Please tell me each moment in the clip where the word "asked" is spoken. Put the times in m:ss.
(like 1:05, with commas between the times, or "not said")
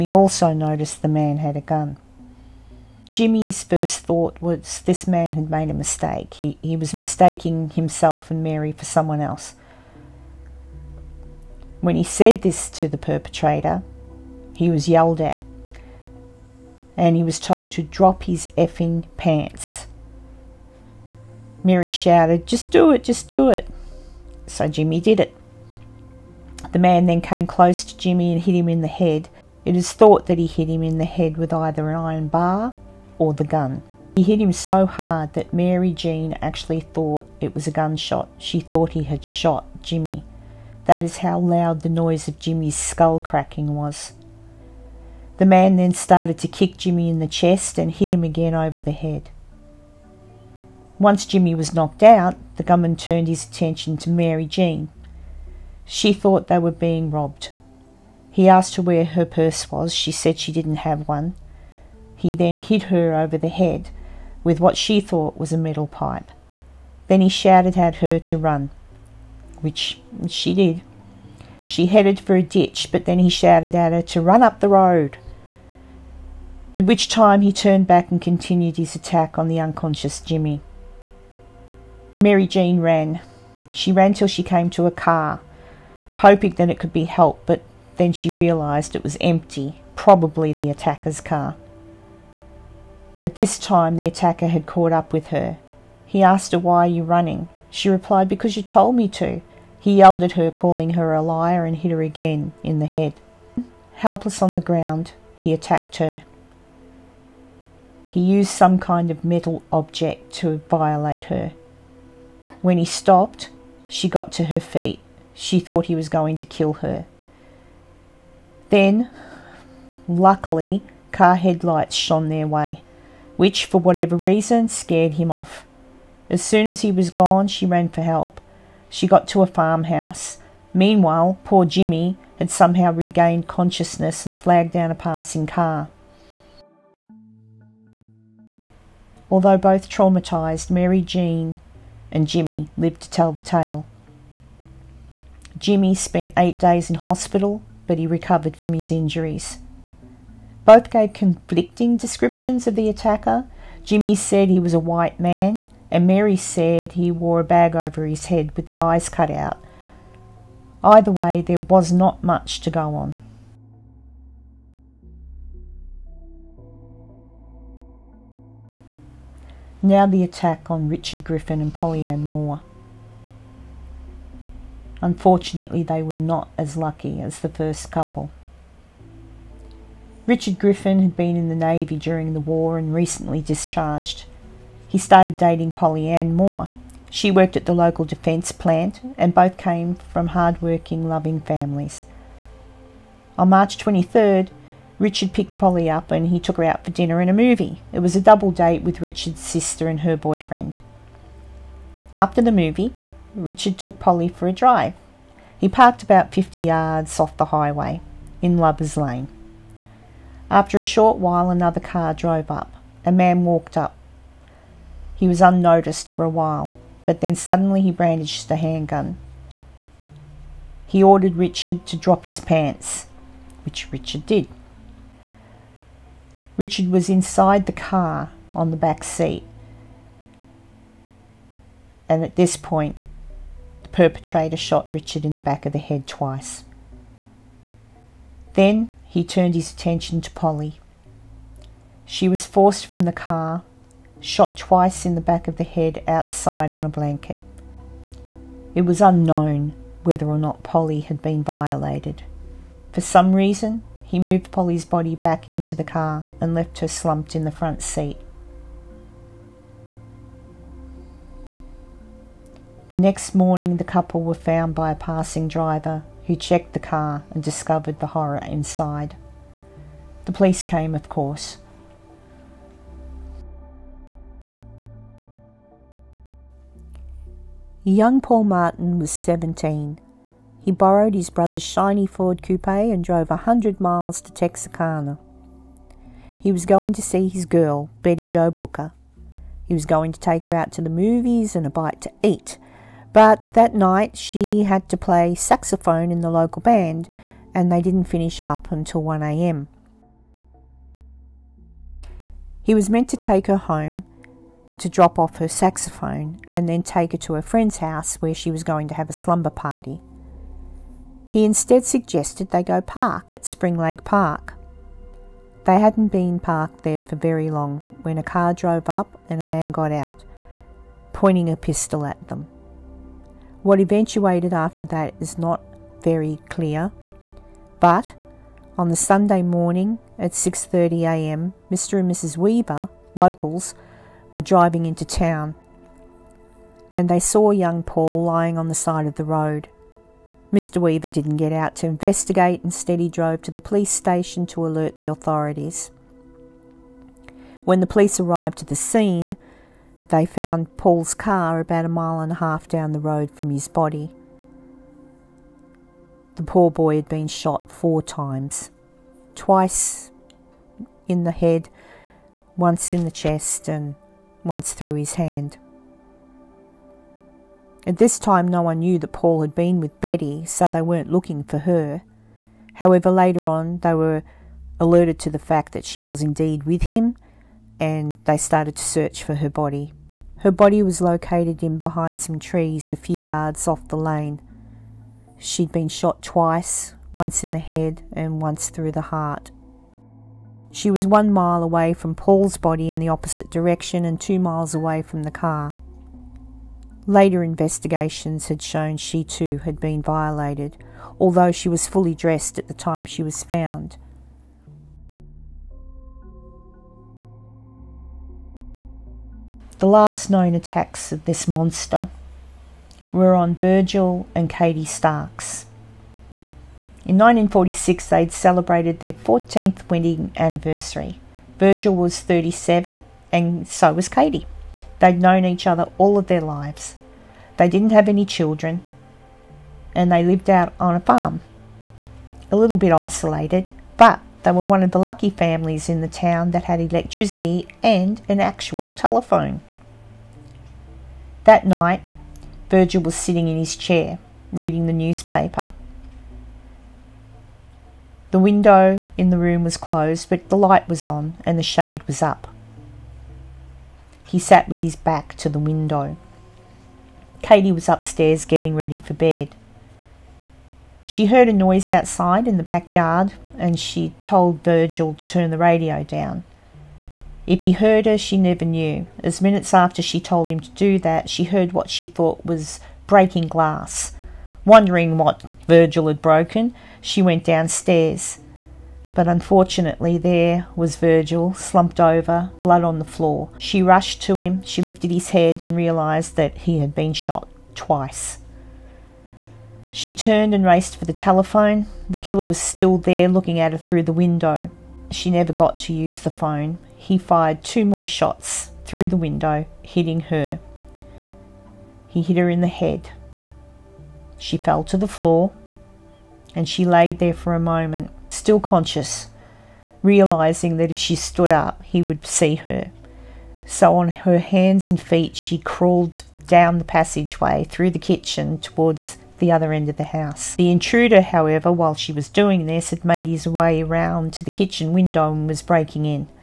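0:58, 1:36.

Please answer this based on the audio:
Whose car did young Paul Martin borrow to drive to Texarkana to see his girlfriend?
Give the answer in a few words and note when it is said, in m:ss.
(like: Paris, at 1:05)
His brother's, at 4:41.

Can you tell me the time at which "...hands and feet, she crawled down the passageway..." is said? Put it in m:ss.
8:34.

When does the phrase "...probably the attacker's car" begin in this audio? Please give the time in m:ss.
1:29.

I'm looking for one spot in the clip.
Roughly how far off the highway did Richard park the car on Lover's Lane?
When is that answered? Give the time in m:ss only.
3:26.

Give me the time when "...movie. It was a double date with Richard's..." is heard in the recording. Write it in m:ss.
3:17.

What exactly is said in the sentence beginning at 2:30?
Both gave conflicting descriptions of the attacker.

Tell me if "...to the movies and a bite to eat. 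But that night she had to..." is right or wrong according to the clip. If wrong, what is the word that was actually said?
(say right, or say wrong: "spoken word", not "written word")
right.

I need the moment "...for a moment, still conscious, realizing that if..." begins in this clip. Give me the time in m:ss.
8:27.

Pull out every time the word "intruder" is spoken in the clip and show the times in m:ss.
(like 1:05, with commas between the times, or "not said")
8:40.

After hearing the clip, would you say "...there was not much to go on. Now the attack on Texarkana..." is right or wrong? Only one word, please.
wrong.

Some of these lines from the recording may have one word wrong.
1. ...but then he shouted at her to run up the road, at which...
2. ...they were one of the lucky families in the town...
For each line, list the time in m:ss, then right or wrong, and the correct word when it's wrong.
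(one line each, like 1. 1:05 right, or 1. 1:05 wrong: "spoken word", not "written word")
1. 1:12 right
2. 7:14 right.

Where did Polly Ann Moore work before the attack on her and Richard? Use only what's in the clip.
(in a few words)
Local defence plant.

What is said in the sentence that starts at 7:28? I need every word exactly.
The window in the room was closed, but the light was on and the shade was up.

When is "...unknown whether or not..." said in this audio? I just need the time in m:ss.
4:09.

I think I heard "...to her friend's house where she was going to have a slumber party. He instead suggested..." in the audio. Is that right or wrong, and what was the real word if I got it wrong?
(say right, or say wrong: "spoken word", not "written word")
right.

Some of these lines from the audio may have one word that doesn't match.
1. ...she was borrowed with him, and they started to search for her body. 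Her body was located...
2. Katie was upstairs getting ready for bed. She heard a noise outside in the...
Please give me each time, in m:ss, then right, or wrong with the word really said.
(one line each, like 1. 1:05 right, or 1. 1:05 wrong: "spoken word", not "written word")
1. 6:15 wrong: "indeed", not "borrowed"
2. 7:37 right.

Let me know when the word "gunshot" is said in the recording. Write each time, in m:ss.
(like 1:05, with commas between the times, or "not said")
0:37.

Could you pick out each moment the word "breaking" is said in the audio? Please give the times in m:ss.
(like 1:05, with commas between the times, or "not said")
7:53, 8:45.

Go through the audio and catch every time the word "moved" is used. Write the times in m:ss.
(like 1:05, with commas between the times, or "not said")
4:14.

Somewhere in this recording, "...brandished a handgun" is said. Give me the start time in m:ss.
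3:37.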